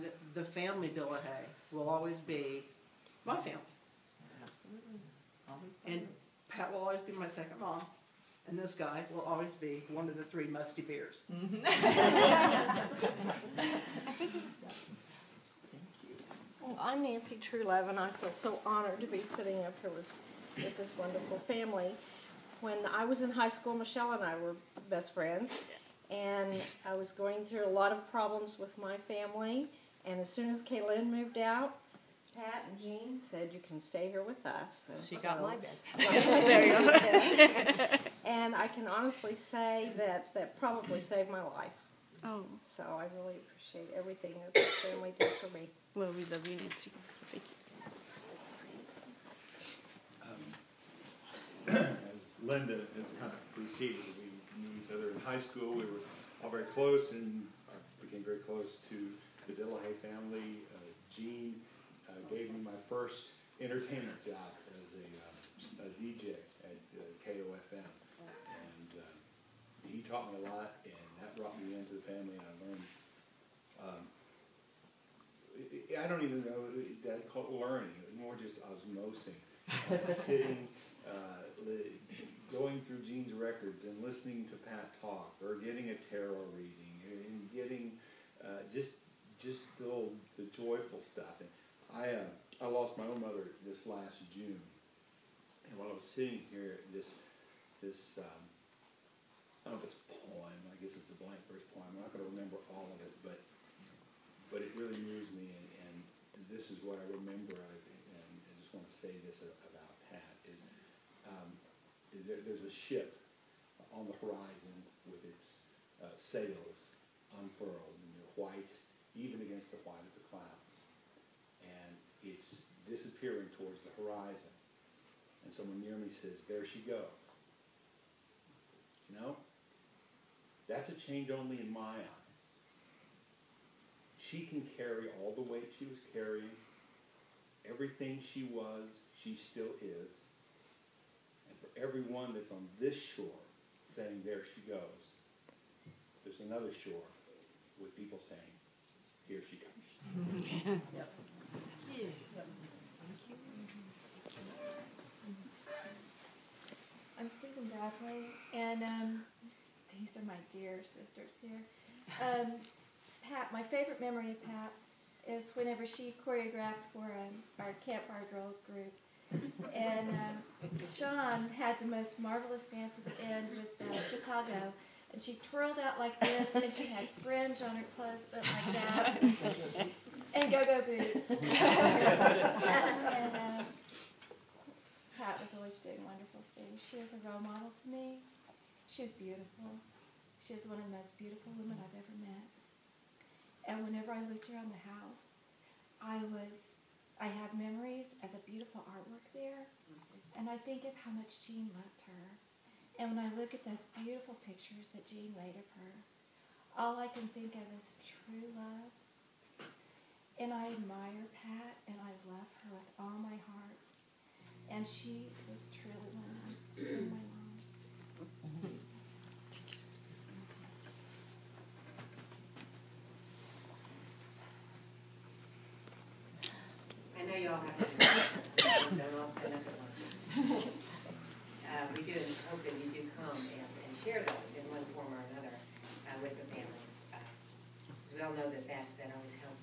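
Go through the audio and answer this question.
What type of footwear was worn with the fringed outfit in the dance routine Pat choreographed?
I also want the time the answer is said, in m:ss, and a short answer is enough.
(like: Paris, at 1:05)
Go-go boots, at 3:00.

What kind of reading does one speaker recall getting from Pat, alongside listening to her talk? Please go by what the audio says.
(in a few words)
Tarot reading.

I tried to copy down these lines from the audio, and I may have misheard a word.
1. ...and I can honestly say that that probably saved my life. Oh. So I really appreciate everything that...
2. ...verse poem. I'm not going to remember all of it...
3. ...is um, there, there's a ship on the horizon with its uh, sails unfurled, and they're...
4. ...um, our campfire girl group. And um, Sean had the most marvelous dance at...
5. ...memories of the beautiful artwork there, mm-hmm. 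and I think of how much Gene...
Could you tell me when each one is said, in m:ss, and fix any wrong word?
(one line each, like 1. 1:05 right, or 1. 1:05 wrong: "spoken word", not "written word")
1. 0:38 right
2. 1:41 right
3. 1:50 right
4. 2:47 right
5. 3:17 right.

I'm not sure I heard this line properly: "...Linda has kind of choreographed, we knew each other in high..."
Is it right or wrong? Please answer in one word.
wrong.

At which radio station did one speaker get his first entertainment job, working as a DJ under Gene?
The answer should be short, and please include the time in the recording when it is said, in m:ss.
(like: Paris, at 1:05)
KOFM, at 1:07.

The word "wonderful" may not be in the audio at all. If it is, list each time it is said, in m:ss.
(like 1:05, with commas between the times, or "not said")
0:20, 3:06.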